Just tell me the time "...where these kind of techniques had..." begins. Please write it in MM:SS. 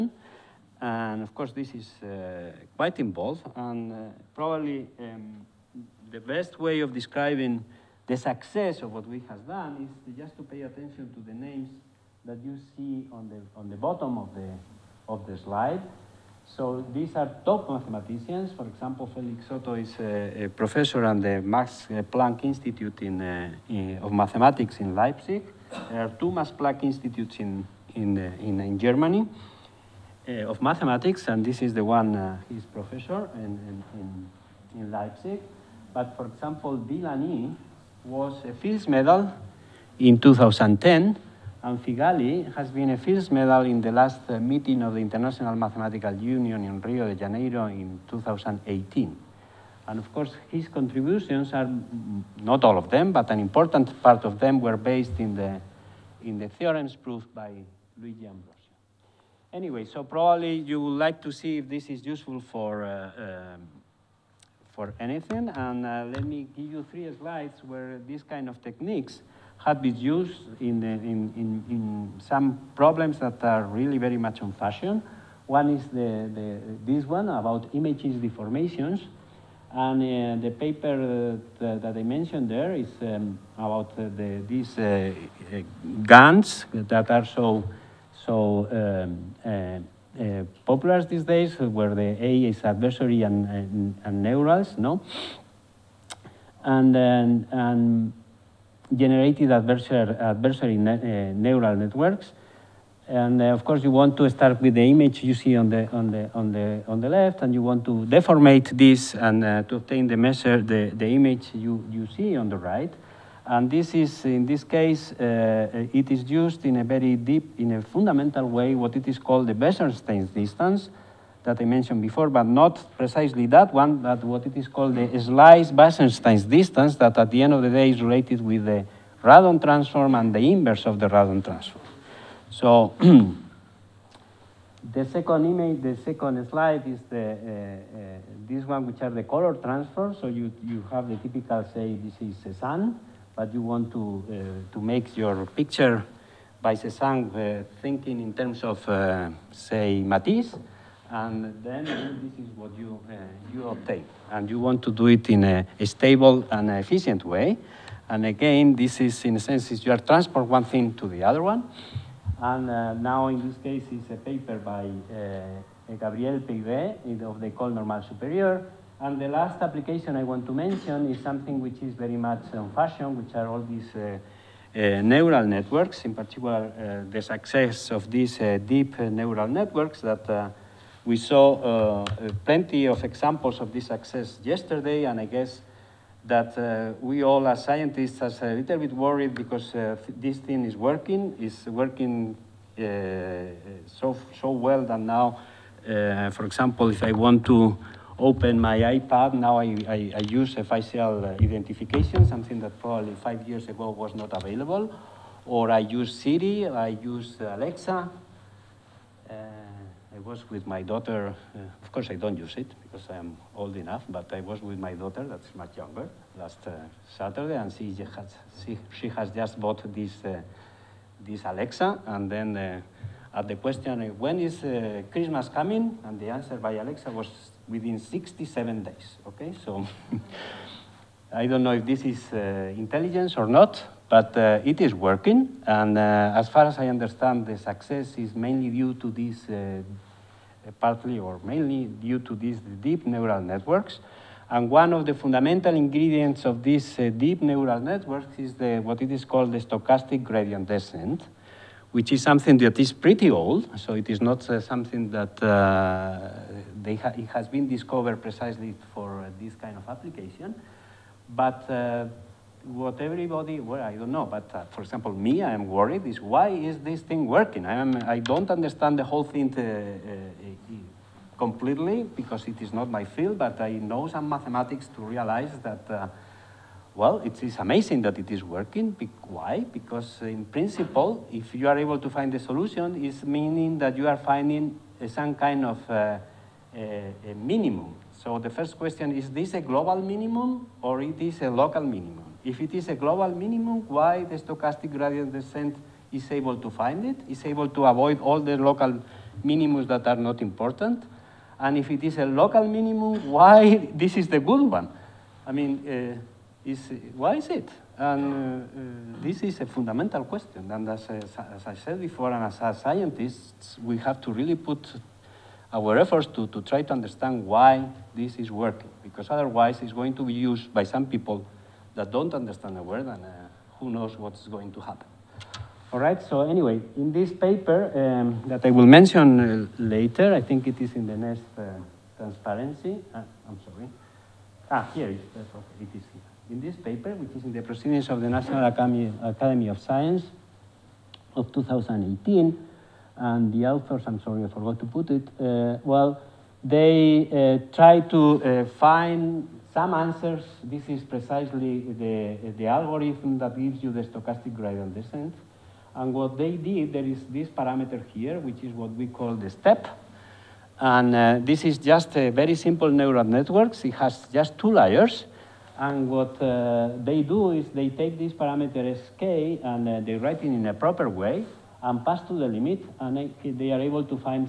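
01:07.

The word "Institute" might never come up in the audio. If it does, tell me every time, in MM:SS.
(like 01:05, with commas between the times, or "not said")
00:22, 00:26.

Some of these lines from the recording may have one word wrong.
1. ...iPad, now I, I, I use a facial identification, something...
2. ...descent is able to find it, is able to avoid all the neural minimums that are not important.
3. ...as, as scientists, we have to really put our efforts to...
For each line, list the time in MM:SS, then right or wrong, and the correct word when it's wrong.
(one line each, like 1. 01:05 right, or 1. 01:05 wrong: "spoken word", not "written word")
1. 03:18 right
2. 04:55 wrong: "local", not "neural"
3. 05:12 right.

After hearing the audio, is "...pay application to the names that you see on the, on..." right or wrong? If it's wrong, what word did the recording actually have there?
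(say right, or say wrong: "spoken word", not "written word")
wrong: "attention", not "application".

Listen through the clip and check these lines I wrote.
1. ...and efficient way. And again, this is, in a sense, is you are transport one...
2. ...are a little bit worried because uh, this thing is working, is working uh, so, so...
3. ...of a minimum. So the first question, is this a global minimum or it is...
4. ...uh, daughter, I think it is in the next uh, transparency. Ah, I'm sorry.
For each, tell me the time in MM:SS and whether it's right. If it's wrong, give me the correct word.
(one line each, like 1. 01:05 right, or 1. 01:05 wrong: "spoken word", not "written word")
1. 02:36 right
2. 03:08 right
3. 04:45 right
4. 05:29 wrong: "later", not "daughter".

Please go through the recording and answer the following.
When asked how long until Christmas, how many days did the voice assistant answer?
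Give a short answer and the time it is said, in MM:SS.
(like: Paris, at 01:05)
67, at 03:47.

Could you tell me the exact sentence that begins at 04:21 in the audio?
But what everybody, well, I don't know, but uh, for example, me, I am worried is why is this thing working?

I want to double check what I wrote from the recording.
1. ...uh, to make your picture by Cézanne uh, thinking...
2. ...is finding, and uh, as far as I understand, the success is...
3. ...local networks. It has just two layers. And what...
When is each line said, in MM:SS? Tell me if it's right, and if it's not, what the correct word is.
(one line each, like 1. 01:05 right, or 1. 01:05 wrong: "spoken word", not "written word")
1. 02:24 right
2. 03:54 wrong: "working", not "finding"
3. 06:02 wrong: "neural", not "local".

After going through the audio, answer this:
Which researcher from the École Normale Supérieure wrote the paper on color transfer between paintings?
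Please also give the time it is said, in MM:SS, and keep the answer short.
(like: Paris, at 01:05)
Gabriel Peyré, at 02:45.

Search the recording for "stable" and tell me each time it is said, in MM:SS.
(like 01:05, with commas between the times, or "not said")
02:35.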